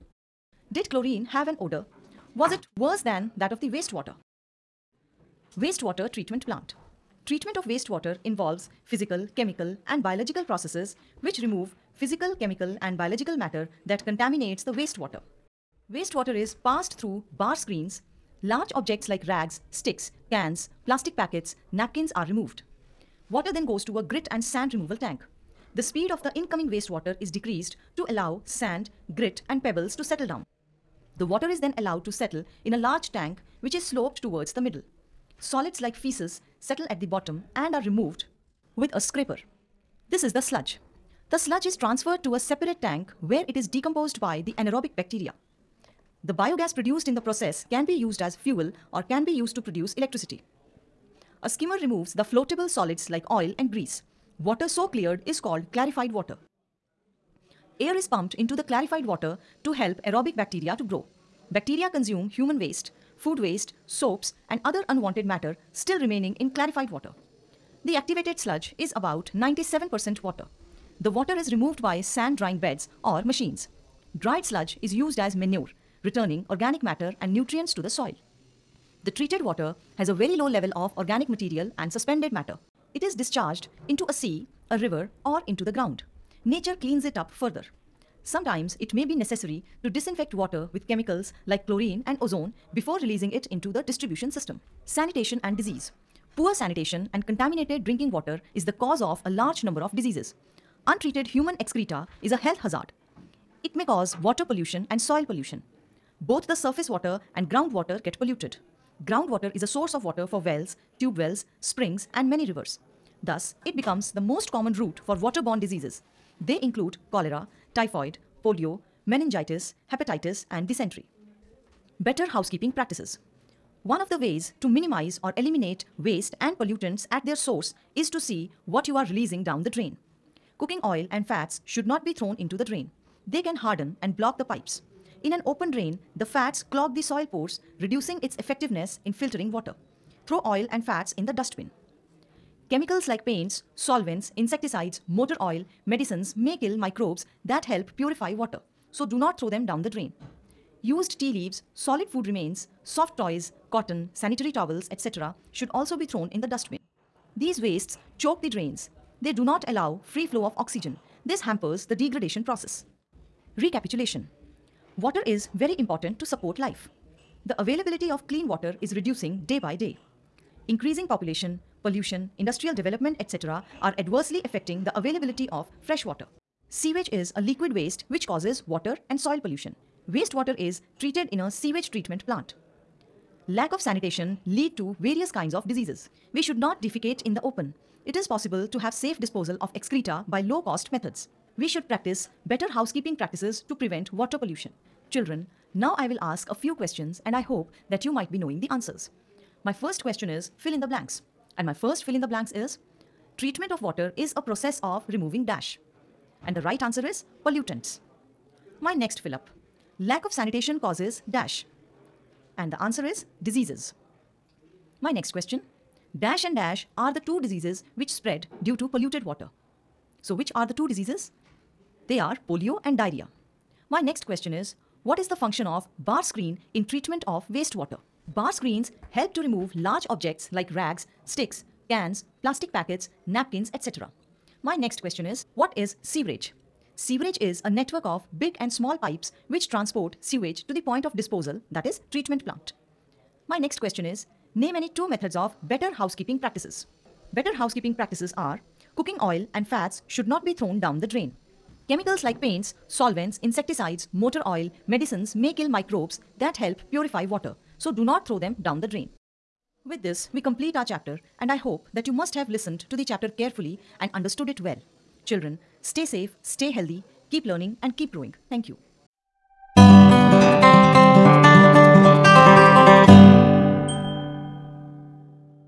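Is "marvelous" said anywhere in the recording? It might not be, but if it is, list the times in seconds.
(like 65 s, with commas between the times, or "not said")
not said.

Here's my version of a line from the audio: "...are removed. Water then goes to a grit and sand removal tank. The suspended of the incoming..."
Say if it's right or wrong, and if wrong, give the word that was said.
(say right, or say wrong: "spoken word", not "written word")
wrong: "speed", not "suspended".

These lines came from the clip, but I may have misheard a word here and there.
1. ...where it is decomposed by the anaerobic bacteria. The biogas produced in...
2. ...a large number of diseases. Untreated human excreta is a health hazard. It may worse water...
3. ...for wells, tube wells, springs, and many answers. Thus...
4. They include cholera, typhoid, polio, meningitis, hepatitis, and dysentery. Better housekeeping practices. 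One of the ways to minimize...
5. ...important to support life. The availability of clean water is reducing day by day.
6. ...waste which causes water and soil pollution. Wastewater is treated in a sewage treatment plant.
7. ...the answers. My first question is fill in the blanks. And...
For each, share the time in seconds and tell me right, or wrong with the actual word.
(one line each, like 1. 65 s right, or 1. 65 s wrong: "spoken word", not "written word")
1. 43 s right
2. 99 s wrong: "cause", not "worse"
3. 110 s wrong: "rivers", not "answers"
4. 116 s right
5. 165 s right
6. 177 s right
7. 198 s right.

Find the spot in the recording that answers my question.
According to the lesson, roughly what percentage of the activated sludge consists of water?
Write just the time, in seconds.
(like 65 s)
69 s.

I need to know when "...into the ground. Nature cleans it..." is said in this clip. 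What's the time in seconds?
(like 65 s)
85 s.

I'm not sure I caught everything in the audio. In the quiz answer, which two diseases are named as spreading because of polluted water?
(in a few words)
polio and diarrhea.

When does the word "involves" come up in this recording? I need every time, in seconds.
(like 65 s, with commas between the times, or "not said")
8 s.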